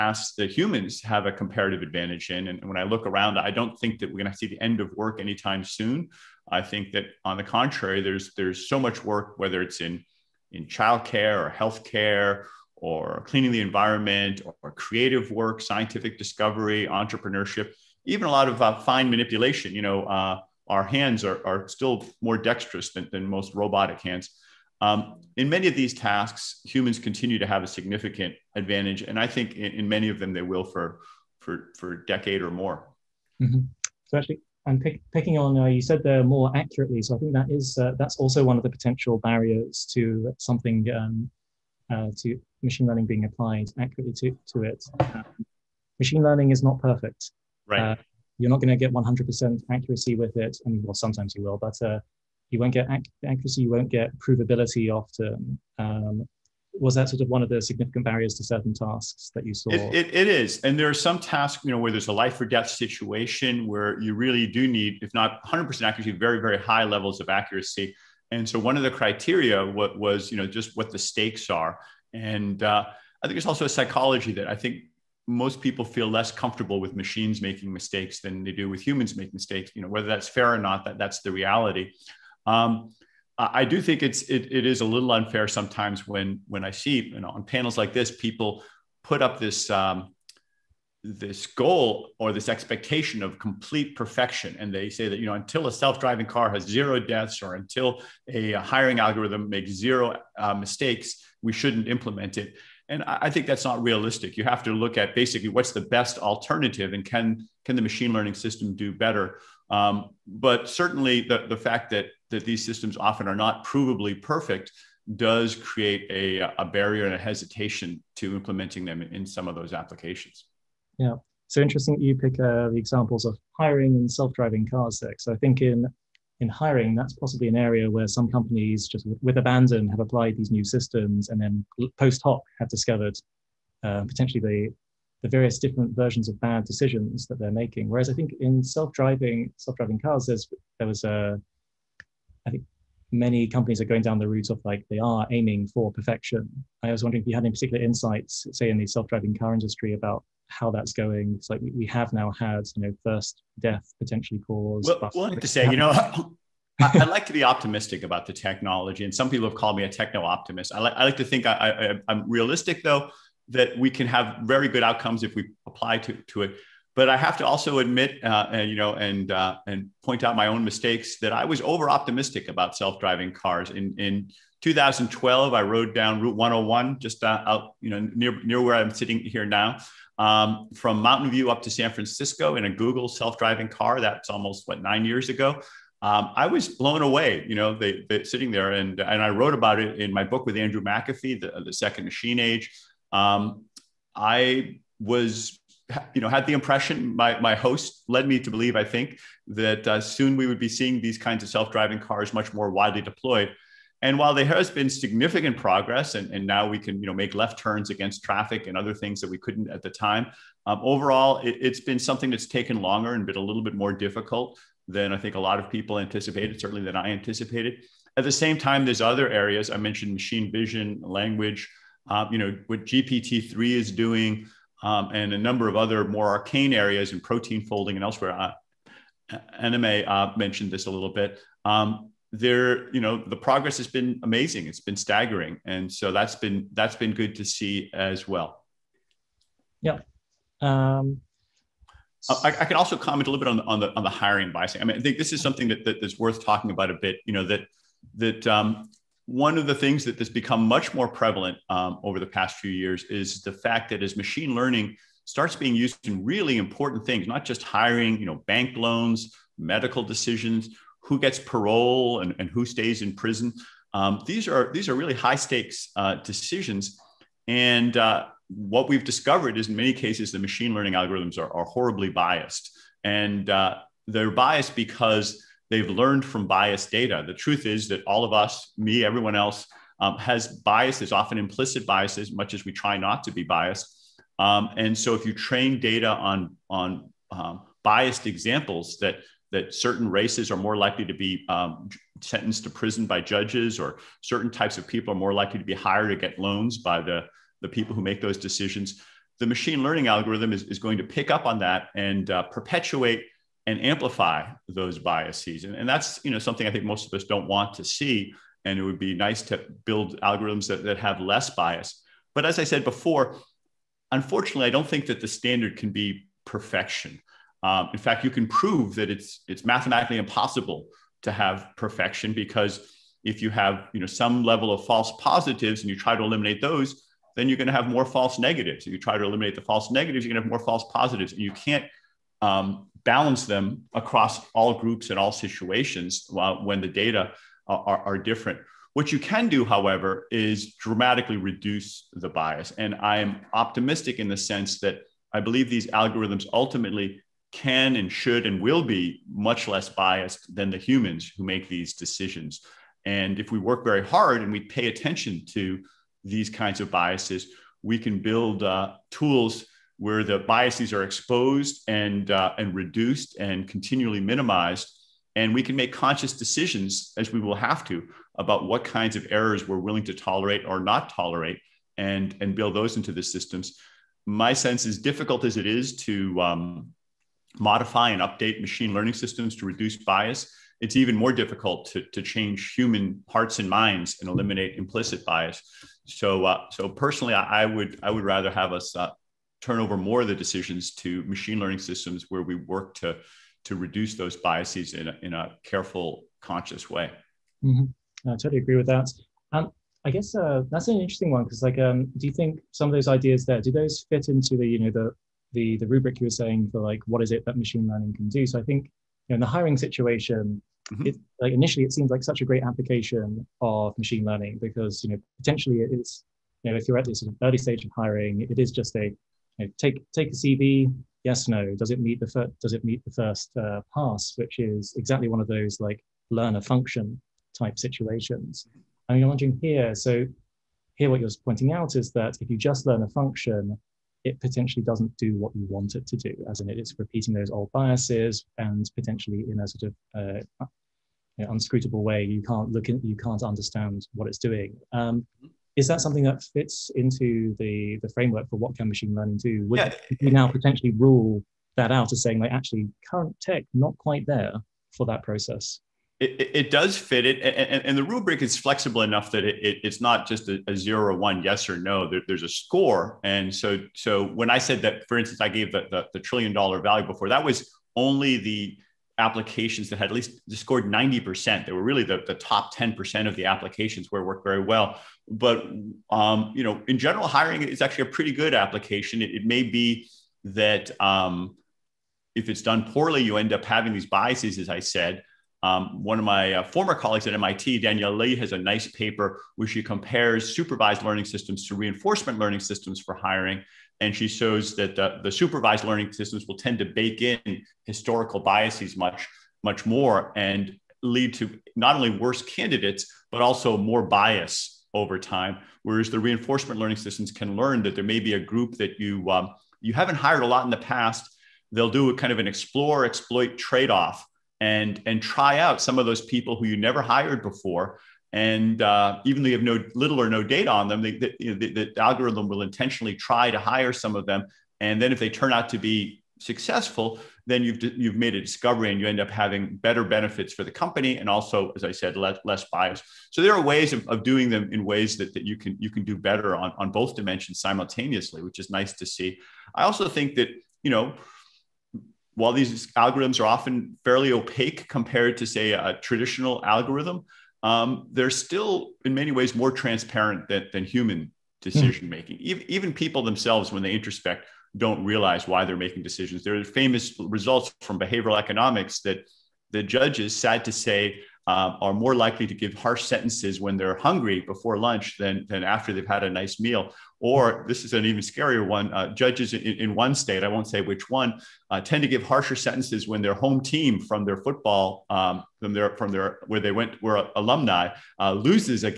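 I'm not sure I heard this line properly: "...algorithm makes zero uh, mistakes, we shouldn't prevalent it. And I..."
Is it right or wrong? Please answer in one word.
wrong.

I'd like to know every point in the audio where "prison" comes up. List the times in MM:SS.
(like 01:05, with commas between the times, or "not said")
04:23, 04:52.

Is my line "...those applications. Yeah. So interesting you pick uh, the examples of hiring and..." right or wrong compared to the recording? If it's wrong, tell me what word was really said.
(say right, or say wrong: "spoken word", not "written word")
right.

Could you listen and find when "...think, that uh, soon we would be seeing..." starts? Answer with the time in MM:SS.
03:18.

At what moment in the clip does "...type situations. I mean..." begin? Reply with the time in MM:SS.
07:07.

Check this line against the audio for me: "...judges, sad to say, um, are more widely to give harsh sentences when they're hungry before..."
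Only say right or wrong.
wrong.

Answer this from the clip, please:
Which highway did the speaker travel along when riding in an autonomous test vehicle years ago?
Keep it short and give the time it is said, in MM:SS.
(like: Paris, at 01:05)
Route 101, at 02:56.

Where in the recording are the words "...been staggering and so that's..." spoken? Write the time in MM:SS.
03:54.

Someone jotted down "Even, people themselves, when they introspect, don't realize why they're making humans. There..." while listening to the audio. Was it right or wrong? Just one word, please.
wrong.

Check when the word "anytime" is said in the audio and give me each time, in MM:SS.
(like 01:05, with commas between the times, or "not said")
00:05.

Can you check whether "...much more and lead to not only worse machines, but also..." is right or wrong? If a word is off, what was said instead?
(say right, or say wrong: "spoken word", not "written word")
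wrong: "candidates", not "machines".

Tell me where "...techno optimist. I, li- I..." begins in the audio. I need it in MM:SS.
02:39.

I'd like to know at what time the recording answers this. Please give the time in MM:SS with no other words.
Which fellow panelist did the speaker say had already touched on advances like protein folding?
03:49.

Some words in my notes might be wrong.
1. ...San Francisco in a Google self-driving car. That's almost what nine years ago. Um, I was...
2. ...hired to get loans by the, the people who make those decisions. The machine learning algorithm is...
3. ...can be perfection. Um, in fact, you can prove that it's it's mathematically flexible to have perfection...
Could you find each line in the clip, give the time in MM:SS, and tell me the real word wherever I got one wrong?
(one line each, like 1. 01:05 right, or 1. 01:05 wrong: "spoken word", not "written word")
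1. 03:01 right
2. 04:55 right
3. 05:15 wrong: "impossible", not "flexible".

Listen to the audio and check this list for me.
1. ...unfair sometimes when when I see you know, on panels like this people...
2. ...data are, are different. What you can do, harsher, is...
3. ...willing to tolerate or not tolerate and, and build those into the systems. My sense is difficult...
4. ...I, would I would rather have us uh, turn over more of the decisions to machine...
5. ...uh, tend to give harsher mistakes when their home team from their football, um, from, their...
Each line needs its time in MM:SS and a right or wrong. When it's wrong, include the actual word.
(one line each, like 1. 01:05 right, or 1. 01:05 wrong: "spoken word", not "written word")
1. 01:25 right
2. 05:36 wrong: "however", not "harsher"
3. 06:09 right
4. 06:27 right
5. 09:31 wrong: "sentences", not "mistakes".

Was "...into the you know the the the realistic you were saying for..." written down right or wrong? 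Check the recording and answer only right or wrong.
wrong.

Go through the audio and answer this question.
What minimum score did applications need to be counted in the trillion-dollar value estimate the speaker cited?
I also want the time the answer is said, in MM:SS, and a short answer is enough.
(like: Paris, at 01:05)
90%, at 07:50.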